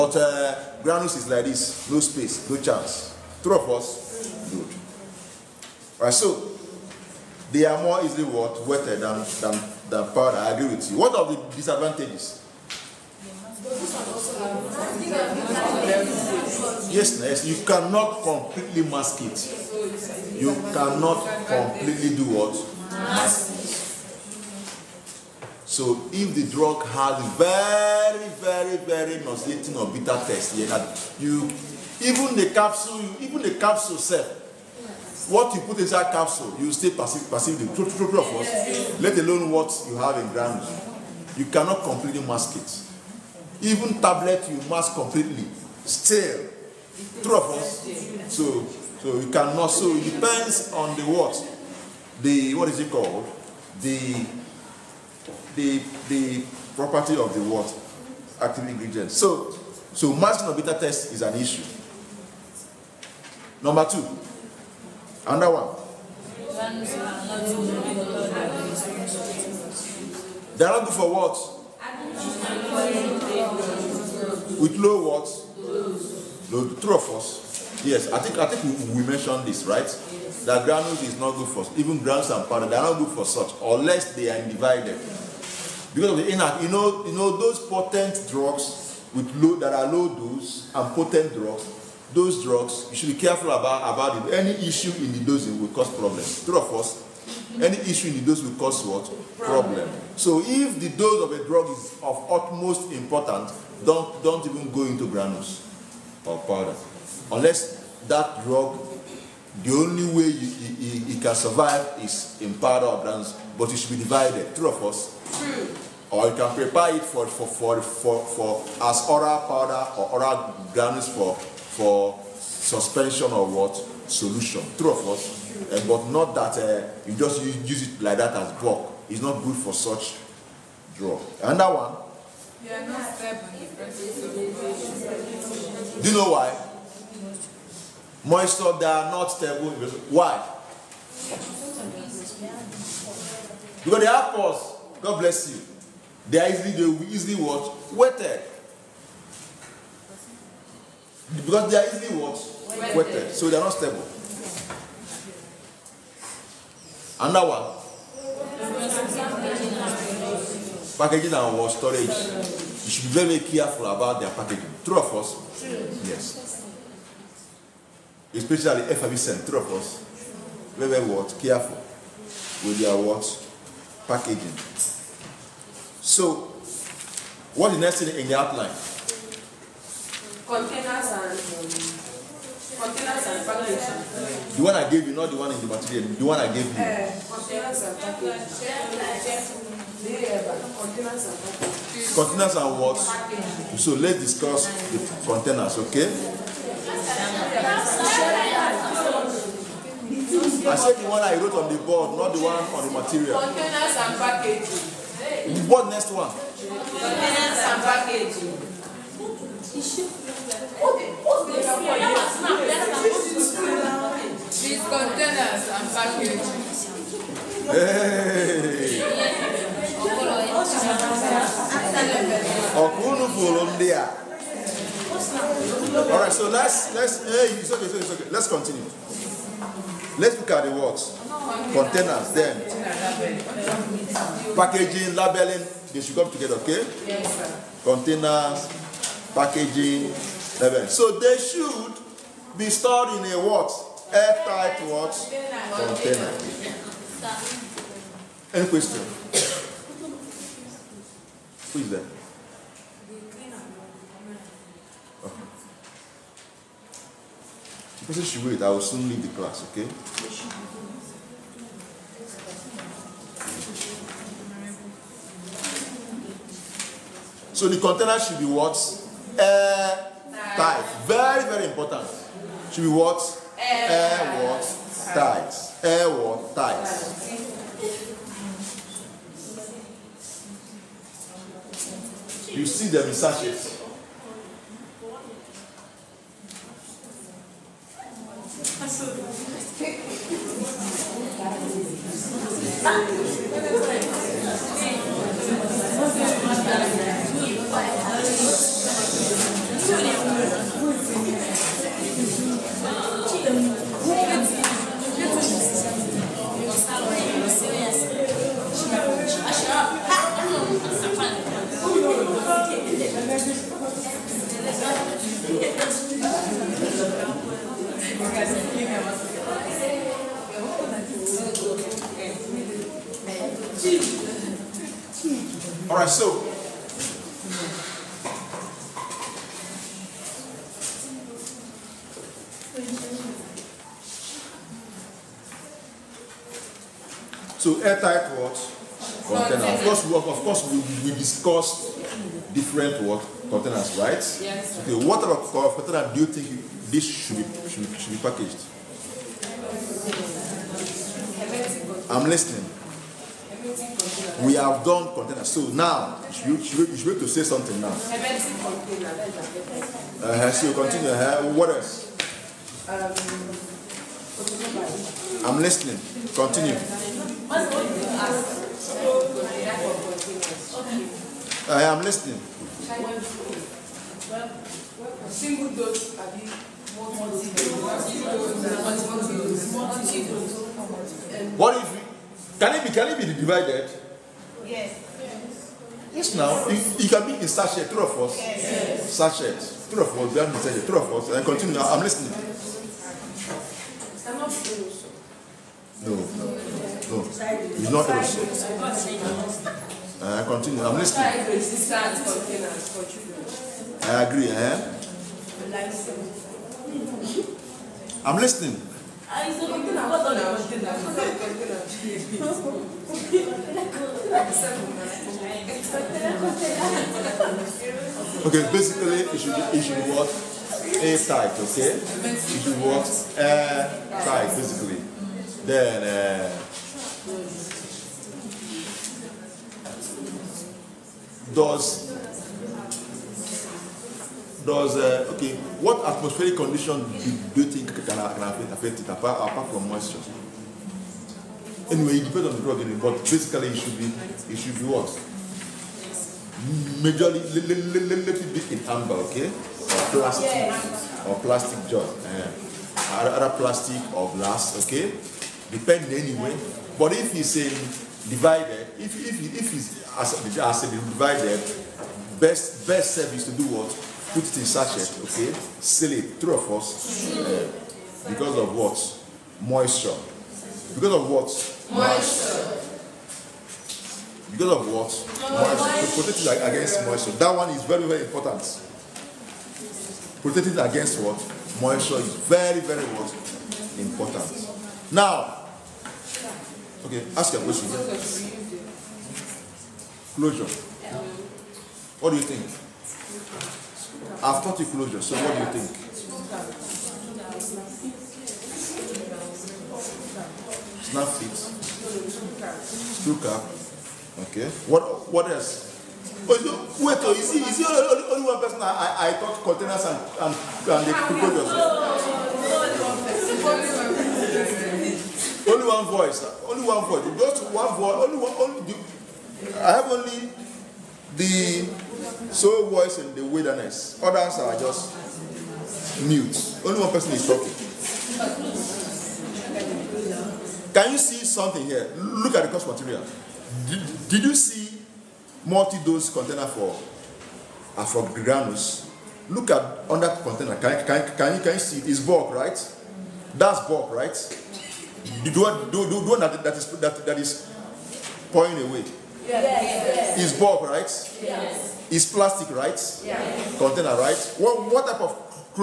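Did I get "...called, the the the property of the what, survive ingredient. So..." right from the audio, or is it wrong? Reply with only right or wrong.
wrong.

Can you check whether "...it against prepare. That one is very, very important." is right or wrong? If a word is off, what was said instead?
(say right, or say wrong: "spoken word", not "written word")
wrong: "moisture", not "prepare".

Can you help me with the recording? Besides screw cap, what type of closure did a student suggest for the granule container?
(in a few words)
Snap fit.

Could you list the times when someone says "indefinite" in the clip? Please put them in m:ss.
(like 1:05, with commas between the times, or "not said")
not said.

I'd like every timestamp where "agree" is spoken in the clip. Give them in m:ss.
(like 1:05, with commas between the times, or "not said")
0:10, 6:44.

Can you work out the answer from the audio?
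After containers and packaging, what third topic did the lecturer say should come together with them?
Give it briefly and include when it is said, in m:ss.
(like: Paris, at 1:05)
Labeling, at 3:55.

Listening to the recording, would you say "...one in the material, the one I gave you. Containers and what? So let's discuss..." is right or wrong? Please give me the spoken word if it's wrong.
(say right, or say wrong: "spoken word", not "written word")
right.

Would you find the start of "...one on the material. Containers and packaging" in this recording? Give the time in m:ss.
3:22.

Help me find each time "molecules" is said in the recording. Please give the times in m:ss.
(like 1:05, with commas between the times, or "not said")
not said.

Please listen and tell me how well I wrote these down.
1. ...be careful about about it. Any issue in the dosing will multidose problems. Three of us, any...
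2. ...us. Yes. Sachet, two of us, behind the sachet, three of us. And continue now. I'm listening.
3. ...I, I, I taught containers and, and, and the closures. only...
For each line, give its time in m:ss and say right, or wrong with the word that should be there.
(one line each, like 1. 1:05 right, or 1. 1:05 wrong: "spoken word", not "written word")
1. 1:33 wrong: "cause", not "multidose"
2. 6:28 right
3. 8:28 right.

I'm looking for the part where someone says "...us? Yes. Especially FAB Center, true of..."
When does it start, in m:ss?
2:45.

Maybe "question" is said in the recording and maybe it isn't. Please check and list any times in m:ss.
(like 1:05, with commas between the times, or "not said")
4:08, 8:07.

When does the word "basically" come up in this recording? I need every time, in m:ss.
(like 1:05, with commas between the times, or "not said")
6:58, 7:04, 7:23.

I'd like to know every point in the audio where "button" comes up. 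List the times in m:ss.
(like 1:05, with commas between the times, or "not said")
not said.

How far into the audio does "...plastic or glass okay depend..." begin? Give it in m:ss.
7:33.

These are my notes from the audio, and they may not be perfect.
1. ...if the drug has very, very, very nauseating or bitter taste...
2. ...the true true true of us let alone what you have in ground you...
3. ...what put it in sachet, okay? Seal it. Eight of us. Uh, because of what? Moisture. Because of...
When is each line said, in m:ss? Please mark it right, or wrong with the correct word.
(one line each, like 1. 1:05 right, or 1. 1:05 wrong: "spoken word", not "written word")
1. 0:26 right
2. 0:37 right
3. 7:43 wrong: "Three", not "Eight".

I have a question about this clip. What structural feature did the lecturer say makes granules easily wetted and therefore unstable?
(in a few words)
Pores.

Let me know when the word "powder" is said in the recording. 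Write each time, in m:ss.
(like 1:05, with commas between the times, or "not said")
0:10, 1:22, 1:46, 1:52, 1:59.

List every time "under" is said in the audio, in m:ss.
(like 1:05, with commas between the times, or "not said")
1:05, 9:00.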